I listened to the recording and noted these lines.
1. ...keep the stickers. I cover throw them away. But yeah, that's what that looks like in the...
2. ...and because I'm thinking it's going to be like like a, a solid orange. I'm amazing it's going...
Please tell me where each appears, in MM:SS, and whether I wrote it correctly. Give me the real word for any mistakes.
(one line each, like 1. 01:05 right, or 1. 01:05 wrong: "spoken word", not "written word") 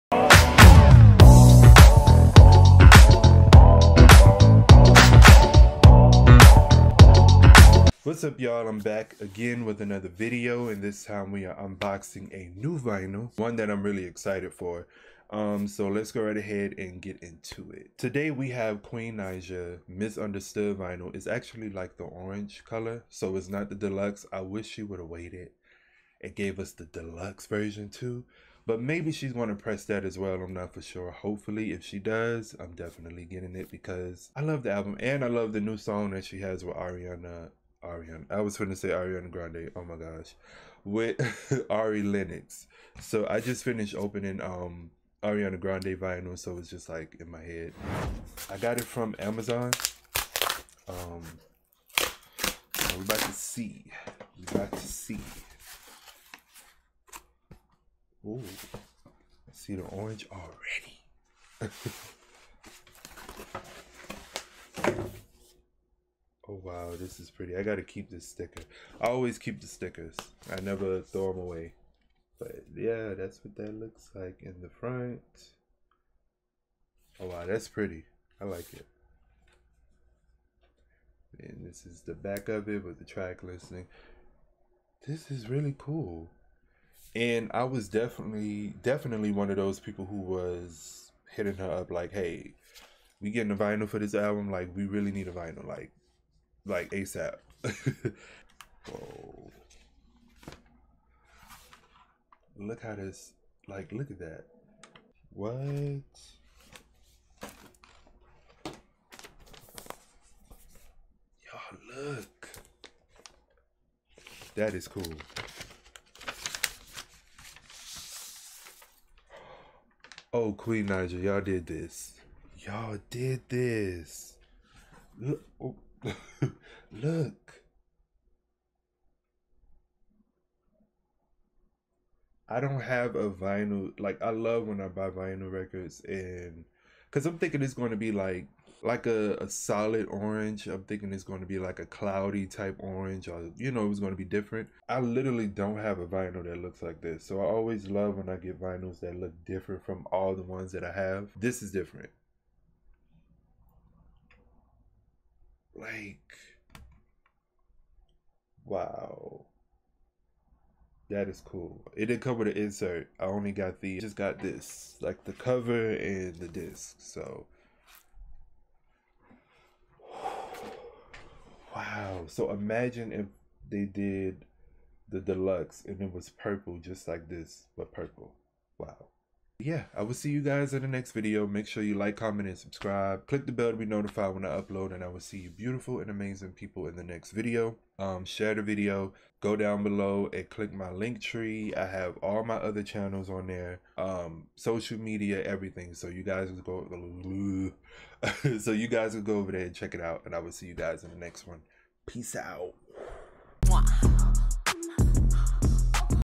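1. 01:09 wrong: "never", not "cover"
2. 02:16 wrong: "thinking", not "amazing".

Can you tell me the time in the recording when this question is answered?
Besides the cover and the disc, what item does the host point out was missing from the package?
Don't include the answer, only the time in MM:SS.
02:42.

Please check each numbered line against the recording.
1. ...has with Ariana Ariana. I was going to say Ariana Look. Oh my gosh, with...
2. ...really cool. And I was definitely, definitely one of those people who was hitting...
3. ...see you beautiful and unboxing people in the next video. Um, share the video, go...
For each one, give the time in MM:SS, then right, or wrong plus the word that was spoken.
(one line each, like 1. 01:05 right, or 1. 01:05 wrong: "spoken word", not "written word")
1. 00:36 wrong: "Grande", not "Look"
2. 01:25 right
3. 03:05 wrong: "amazing", not "unboxing".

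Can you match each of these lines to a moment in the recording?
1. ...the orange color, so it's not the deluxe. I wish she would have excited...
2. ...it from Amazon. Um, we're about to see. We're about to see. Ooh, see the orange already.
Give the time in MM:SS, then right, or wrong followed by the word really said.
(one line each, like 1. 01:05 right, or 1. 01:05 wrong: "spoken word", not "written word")
1. 00:21 wrong: "waited", not "excited"
2. 00:48 right.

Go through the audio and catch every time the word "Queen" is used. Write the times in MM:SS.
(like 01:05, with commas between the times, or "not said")
00:18, 02:00.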